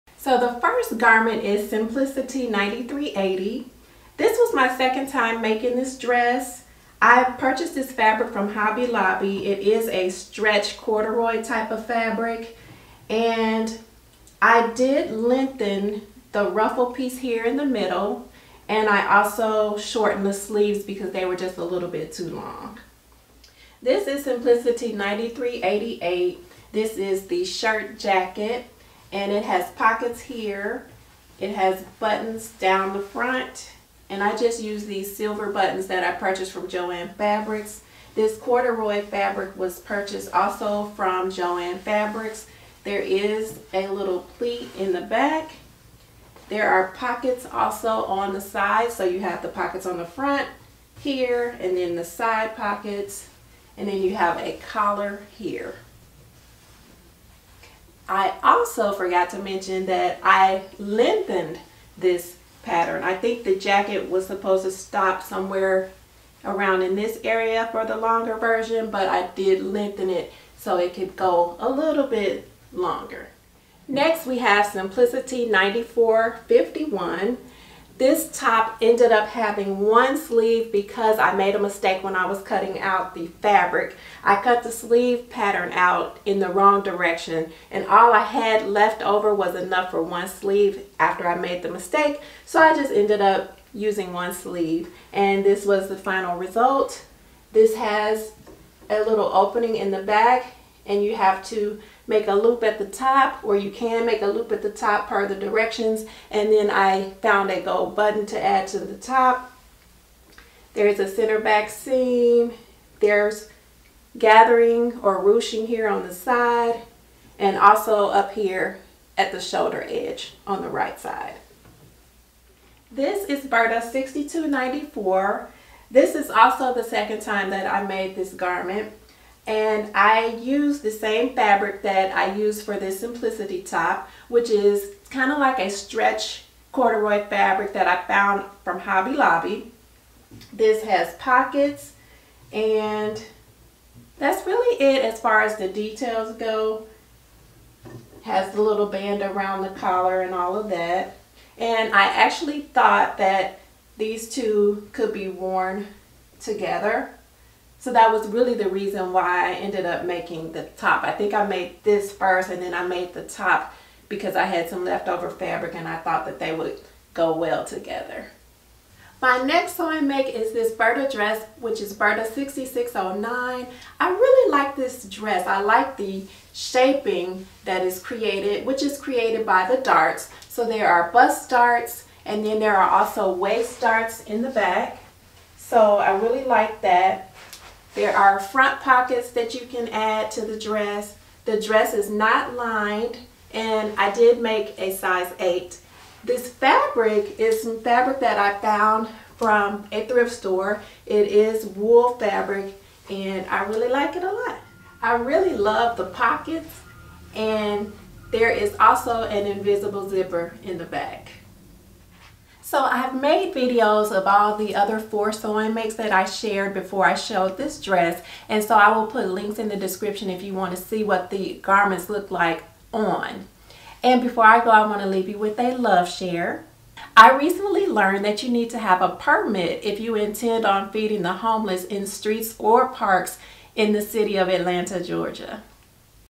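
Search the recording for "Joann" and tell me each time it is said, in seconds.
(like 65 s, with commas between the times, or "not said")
36 s, 41 s.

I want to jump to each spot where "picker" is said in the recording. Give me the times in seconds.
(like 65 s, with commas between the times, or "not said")
not said.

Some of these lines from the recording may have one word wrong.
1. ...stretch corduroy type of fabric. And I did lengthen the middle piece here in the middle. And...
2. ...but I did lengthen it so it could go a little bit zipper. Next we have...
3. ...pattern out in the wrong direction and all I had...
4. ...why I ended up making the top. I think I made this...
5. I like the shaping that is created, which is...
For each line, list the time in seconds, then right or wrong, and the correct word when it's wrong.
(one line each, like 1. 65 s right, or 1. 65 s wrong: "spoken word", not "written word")
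1. 10 s wrong: "ruffle", not "middle"
2. 68 s wrong: "longer", not "zipper"
3. 85 s right
4. 159 s right
5. 175 s right.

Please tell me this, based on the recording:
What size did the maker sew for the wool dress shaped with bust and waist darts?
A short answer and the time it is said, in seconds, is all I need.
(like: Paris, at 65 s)
8, at 194 s.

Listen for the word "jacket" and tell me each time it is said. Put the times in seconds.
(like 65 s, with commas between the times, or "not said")
27 s, 63 s.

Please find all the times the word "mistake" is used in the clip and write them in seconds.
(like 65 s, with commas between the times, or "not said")
81 s, 91 s.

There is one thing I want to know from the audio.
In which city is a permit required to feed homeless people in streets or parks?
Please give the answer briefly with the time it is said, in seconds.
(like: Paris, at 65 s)
Atlanta, Georgia, at 234 s.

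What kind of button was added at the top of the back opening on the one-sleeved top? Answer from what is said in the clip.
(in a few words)
gold button.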